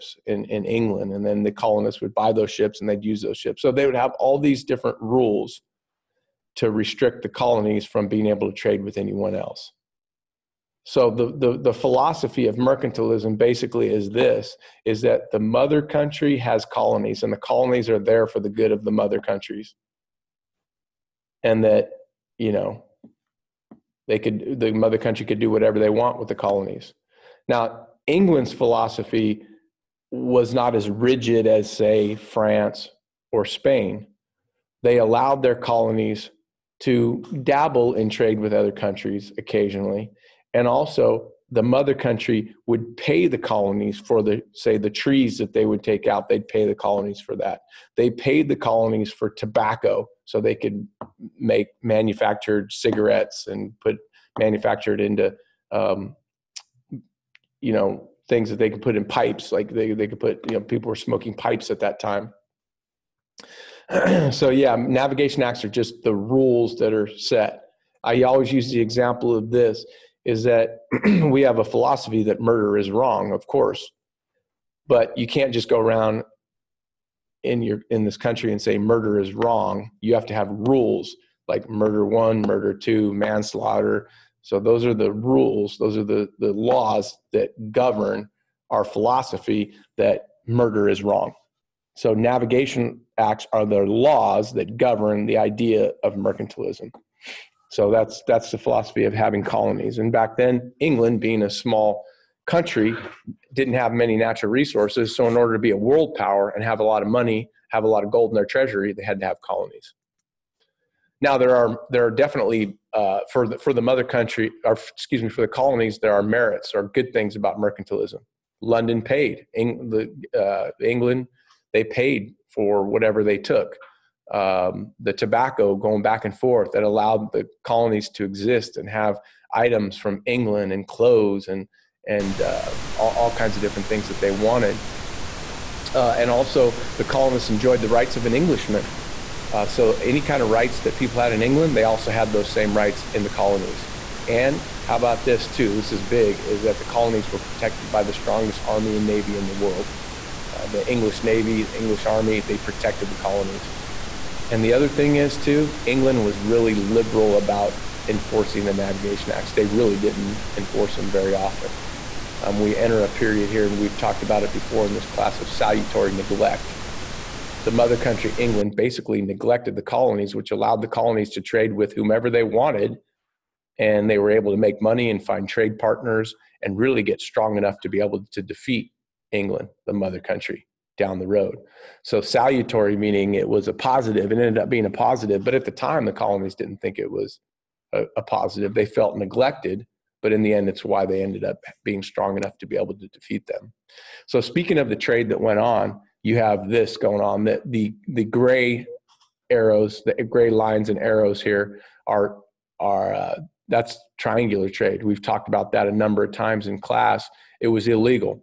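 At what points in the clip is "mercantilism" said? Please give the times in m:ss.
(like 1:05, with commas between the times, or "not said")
0:12, 1:36, 1:57.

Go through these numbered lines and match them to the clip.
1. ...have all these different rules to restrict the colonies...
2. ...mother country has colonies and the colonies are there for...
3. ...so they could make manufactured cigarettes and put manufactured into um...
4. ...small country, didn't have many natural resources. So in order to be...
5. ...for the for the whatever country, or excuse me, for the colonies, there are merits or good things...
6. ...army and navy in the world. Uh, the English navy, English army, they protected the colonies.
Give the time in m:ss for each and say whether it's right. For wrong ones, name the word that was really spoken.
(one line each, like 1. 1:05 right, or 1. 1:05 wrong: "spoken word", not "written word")
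1. 0:03 right
2. 0:15 right
3. 0:50 right
4. 1:41 right
5. 1:53 wrong: "mother", not "whatever"
6. 2:28 right.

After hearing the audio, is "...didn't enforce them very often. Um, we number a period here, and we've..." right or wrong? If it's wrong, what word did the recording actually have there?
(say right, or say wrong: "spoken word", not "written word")
wrong: "enter", not "number".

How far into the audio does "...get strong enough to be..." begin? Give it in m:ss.
2:57.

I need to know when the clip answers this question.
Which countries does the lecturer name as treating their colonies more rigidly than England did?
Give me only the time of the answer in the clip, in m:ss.
0:32.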